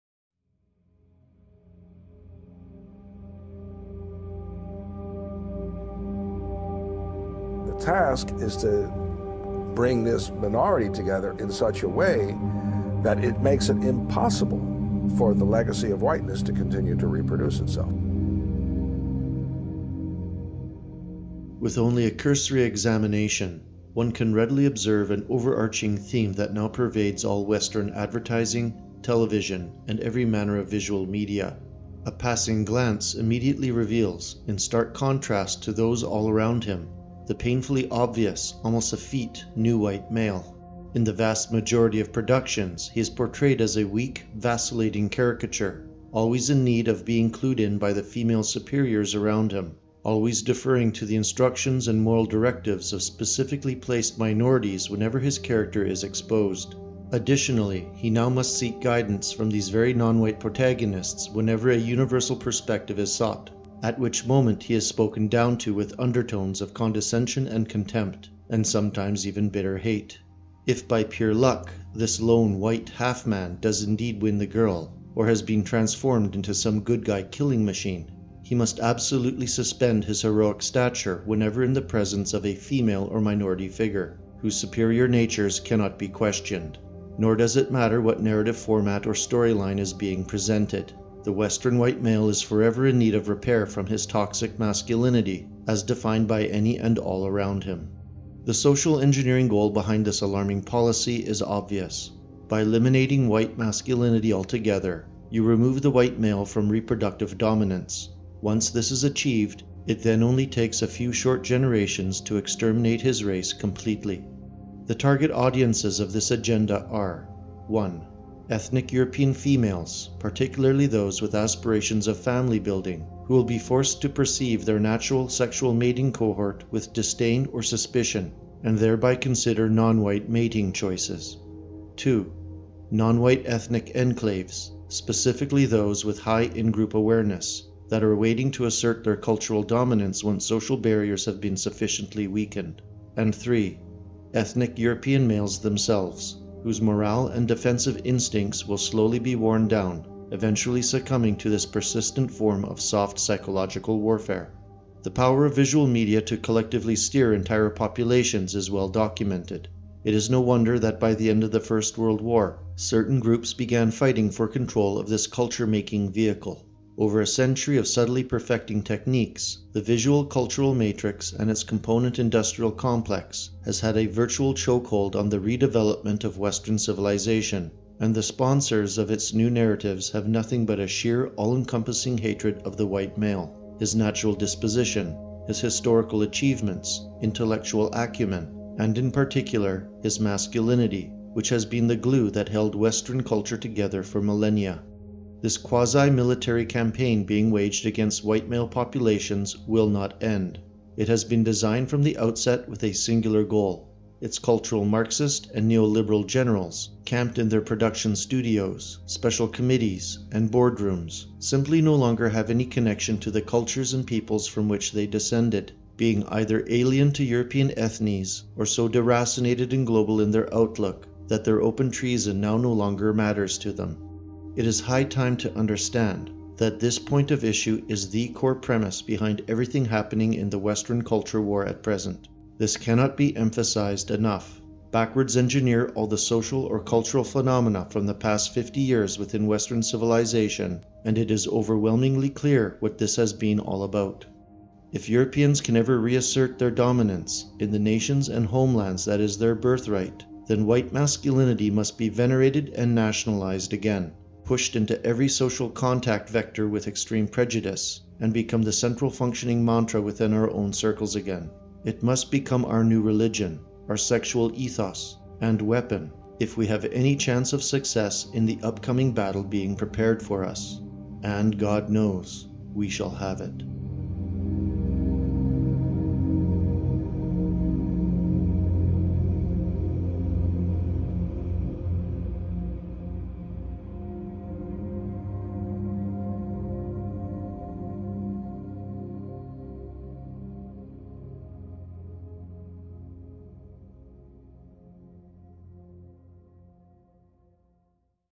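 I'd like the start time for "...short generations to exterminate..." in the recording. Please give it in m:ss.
1:51.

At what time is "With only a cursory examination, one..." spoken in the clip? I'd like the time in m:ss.
0:21.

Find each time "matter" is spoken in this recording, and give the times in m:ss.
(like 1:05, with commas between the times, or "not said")
1:27, 3:43.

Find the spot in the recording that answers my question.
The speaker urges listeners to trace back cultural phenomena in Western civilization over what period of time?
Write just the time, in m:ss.
3:58.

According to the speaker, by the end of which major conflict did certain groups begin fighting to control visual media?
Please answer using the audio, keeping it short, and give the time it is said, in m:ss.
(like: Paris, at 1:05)
First World War, at 2:41.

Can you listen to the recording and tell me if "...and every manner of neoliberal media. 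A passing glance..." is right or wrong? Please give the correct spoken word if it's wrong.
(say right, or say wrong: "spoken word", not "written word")
wrong: "visual", not "neoliberal".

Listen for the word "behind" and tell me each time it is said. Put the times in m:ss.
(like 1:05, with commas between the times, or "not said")
1:39, 3:49.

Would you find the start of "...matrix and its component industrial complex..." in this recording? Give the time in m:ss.
2:50.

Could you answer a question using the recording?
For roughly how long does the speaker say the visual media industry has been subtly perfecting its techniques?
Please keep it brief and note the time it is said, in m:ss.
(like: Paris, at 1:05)
a century, at 2:47.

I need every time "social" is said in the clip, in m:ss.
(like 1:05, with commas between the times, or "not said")
1:38, 2:20, 3:56, 4:15.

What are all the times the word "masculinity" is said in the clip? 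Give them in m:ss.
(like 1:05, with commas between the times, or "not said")
1:34, 1:43, 3:10, 4:10.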